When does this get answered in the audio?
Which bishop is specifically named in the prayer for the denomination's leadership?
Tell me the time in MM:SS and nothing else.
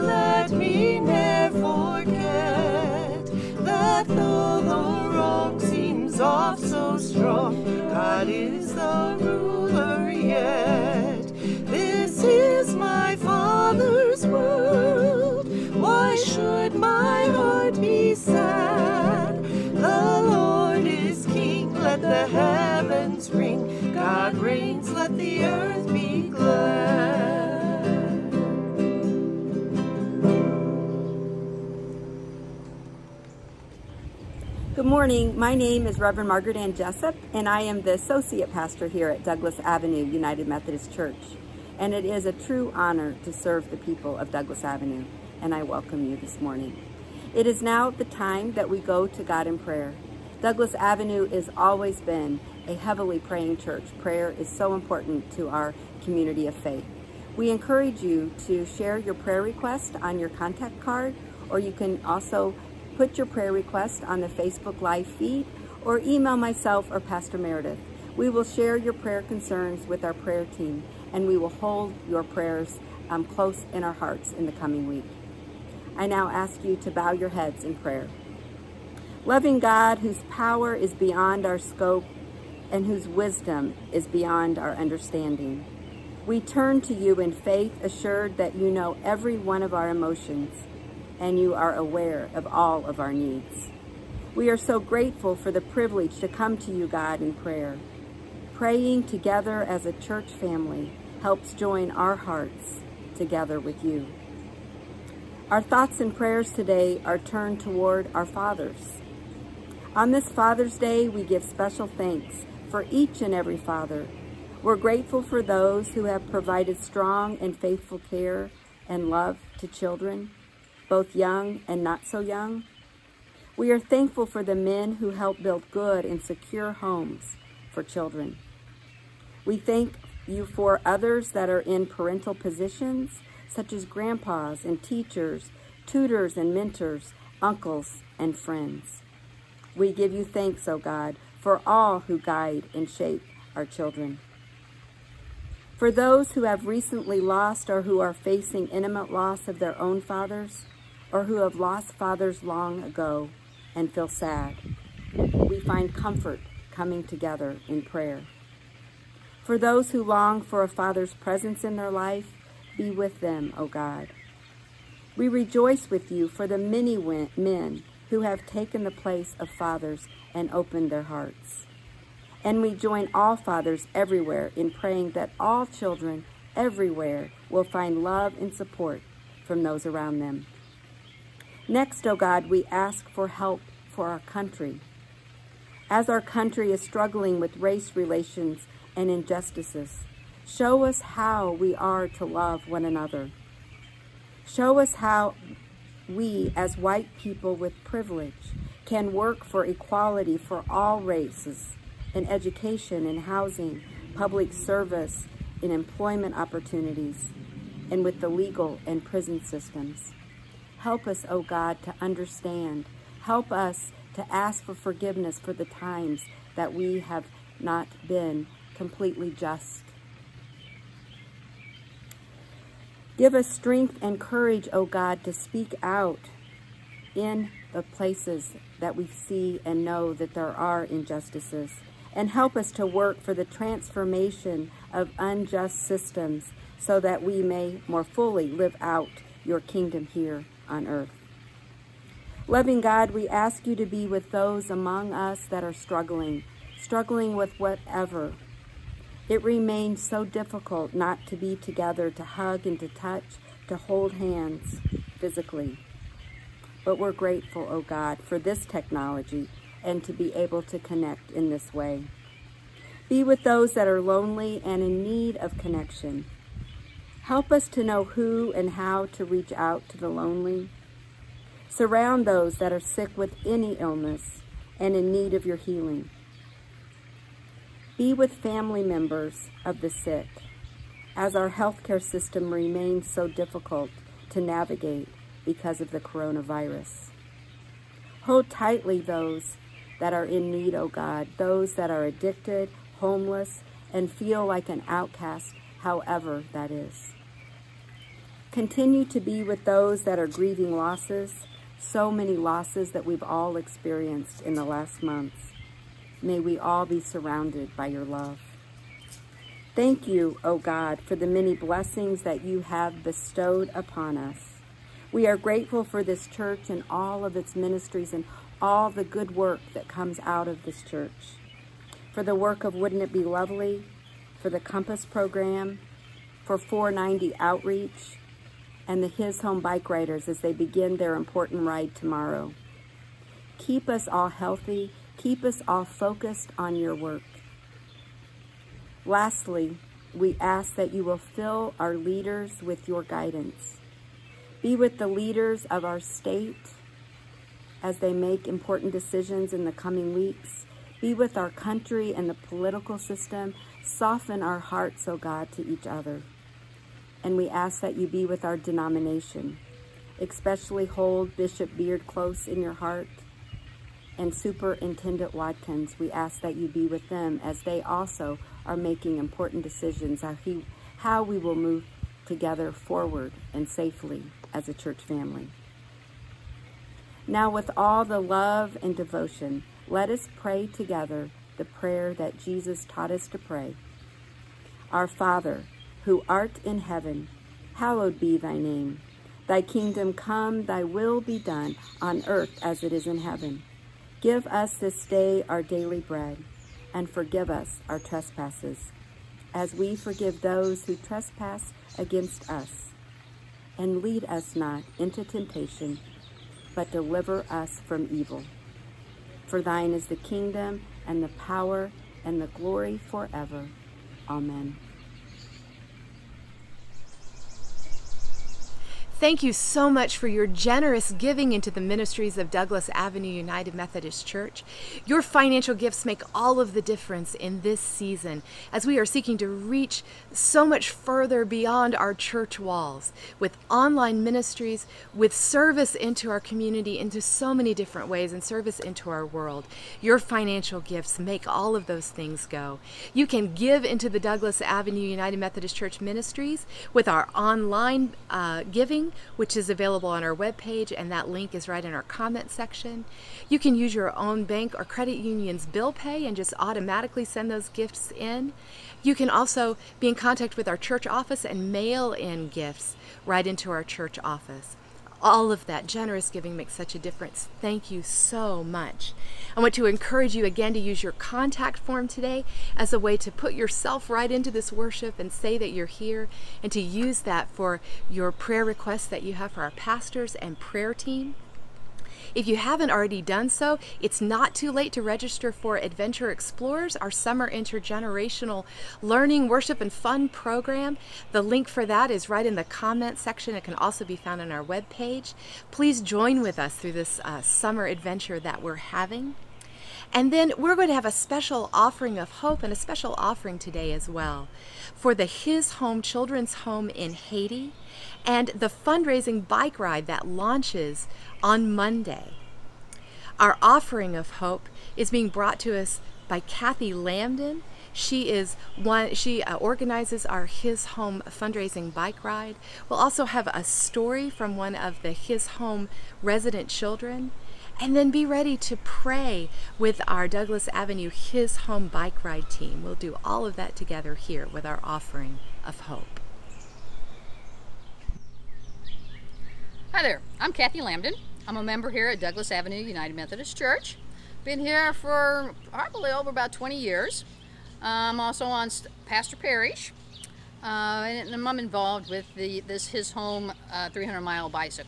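06:01.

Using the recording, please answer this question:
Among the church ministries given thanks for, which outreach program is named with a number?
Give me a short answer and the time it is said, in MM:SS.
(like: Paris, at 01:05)
490 Outreach, at 05:26.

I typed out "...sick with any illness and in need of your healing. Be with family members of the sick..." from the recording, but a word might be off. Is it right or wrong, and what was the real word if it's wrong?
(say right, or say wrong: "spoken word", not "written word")
right.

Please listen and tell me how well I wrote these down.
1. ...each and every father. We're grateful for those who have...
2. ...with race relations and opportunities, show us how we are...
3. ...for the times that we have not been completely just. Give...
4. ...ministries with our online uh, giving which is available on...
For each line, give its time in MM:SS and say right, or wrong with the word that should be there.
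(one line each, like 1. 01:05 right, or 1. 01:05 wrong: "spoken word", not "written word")
1. 01:52 right
2. 03:07 wrong: "injustices", not "opportunities"
3. 03:35 right
4. 07:26 right.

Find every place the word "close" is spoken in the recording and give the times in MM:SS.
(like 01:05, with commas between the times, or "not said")
01:13, 06:02.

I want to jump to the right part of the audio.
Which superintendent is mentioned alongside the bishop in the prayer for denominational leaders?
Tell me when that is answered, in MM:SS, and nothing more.
06:04.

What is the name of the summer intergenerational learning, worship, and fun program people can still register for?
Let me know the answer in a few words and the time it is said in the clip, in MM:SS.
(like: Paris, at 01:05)
Adventure Explorers, at 08:05.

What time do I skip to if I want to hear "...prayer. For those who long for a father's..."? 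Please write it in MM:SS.
02:37.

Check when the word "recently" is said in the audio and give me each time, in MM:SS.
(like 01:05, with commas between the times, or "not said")
02:26.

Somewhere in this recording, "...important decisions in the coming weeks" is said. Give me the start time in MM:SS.
05:48.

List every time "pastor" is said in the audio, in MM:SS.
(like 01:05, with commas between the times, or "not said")
00:38, 01:07, 07:59, 09:09.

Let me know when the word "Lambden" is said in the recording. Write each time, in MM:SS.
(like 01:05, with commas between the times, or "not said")
08:36, 09:00.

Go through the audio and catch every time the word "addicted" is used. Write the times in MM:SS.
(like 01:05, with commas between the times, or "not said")
04:52.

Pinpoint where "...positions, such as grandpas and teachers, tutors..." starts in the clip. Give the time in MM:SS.
02:12.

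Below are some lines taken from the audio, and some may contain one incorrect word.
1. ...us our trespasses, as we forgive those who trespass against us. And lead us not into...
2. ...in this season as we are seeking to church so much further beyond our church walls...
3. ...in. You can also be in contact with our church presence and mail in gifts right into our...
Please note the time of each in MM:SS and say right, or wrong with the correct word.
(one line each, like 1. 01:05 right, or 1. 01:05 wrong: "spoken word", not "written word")
1. 06:37 right
2. 07:07 wrong: "reach", not "church"
3. 07:38 wrong: "office", not "presence".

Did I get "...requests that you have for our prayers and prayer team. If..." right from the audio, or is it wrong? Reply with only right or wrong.
wrong.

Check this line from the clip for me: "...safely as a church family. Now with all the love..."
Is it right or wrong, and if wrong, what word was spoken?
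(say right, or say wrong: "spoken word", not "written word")
right.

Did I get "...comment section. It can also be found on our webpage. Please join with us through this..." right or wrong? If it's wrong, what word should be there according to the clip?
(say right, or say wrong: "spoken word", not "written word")
right.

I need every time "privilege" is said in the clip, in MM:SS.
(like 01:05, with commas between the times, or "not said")
01:35, 03:17.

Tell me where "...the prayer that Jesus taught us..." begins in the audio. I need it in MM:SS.
06:21.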